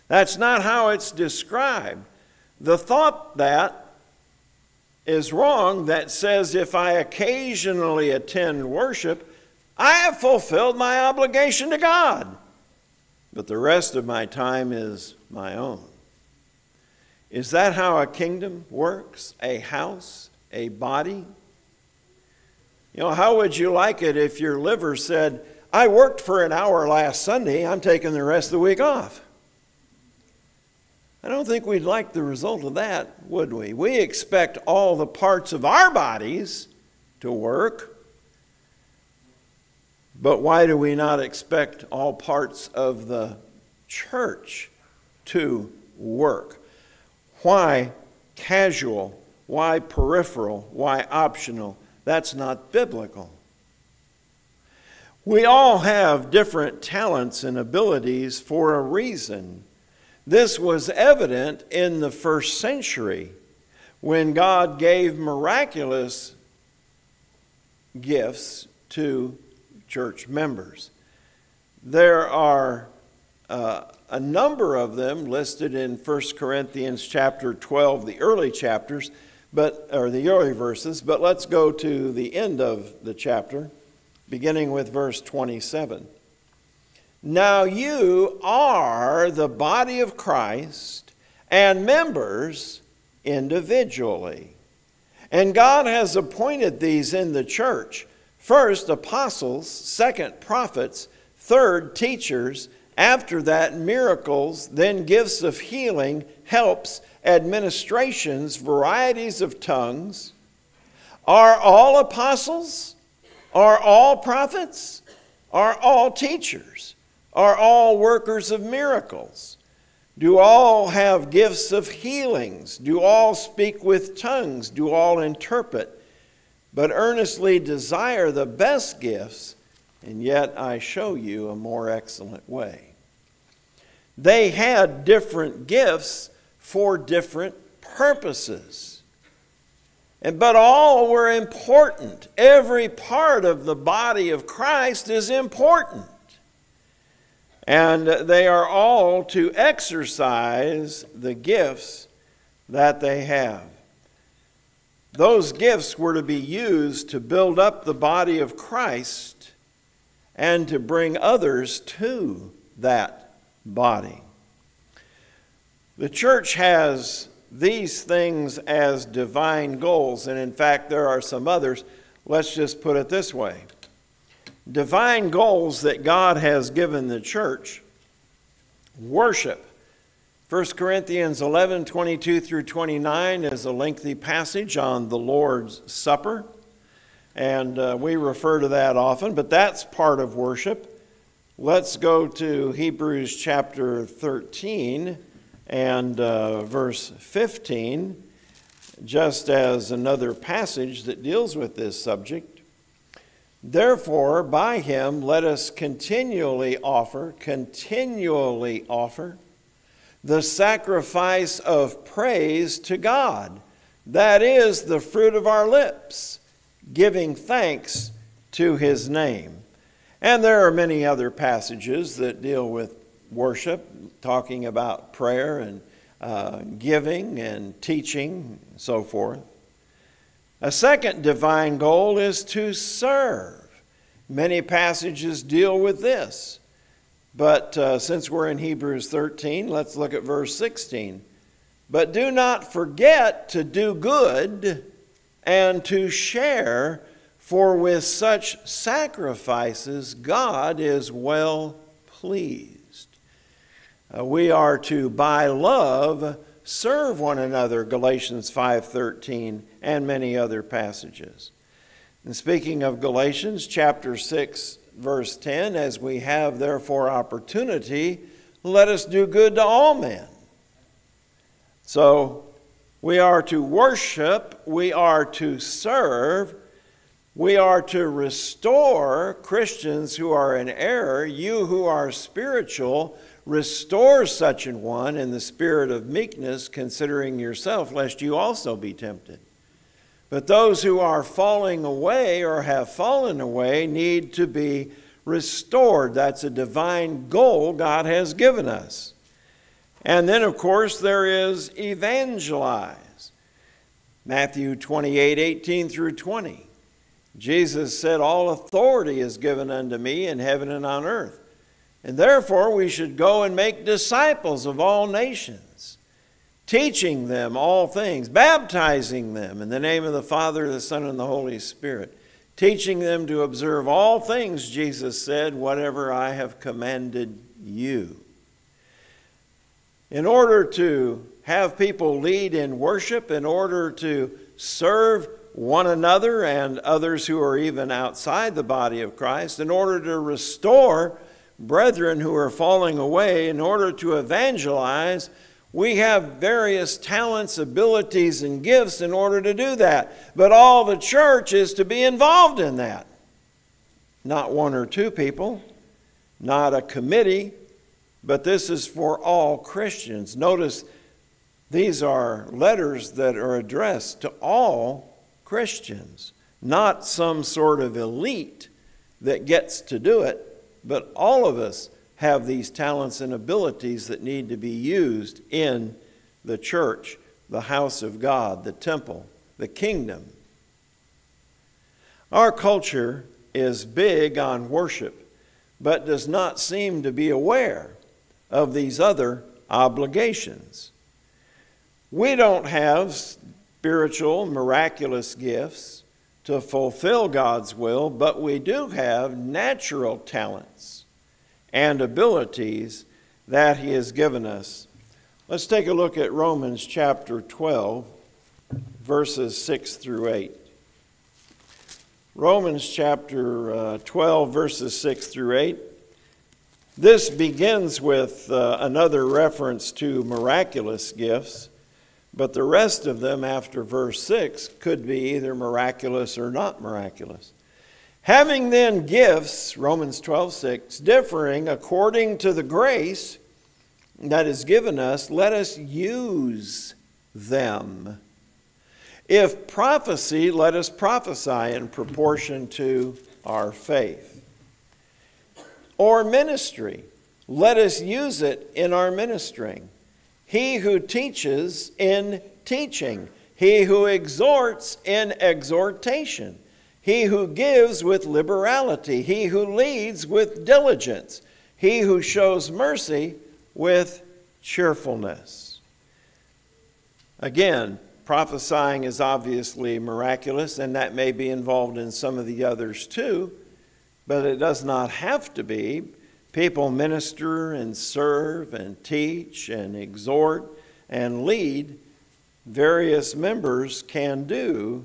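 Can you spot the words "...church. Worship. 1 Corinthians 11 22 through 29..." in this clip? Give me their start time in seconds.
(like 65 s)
177 s.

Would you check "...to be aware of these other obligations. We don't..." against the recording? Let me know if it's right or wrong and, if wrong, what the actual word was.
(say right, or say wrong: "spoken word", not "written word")
right.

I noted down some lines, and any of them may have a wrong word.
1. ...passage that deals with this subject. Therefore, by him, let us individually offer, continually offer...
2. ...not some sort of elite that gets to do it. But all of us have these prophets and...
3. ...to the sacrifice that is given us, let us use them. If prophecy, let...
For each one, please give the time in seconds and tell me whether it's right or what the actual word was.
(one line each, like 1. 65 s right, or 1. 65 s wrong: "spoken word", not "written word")
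1. 200 s wrong: "continually", not "individually"
2. 366 s wrong: "talents", not "prophets"
3. 432 s wrong: "grace", not "sacrifice".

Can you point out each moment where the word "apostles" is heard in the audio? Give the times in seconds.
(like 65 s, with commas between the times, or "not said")
98 s, 111 s.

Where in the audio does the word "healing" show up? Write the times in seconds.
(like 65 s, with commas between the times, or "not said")
105 s, 121 s.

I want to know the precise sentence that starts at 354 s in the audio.
Not one or two people, not a committee, but this is for all Christians.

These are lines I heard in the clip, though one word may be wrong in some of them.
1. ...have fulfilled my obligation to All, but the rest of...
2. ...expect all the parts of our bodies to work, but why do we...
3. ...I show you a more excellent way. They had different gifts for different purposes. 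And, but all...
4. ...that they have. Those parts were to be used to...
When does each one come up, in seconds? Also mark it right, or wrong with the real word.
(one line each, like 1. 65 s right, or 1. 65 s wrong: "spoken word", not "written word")
1. 9 s wrong: "God", not "All"
2. 33 s right
3. 130 s right
4. 152 s wrong: "gifts", not "parts".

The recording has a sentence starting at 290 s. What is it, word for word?
But those who are falling away or have fallen away need to be restored.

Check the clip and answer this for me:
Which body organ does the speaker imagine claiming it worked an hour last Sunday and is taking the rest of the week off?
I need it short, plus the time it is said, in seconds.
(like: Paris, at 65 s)
liver, at 24 s.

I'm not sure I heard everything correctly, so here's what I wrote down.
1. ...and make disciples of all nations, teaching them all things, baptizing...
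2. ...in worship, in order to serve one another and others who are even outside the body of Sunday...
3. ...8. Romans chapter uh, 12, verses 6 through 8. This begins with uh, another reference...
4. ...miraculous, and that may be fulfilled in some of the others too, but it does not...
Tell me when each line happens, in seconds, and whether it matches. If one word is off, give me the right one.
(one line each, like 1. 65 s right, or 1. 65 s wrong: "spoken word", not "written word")
1. 313 s right
2. 332 s wrong: "Christ", not "Sunday"
3. 410 s right
4. 469 s wrong: "involved", not "fulfilled".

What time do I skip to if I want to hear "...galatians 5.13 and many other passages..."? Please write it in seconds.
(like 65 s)
257 s.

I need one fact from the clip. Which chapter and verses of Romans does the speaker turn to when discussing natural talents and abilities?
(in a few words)
Romans 12:6-8.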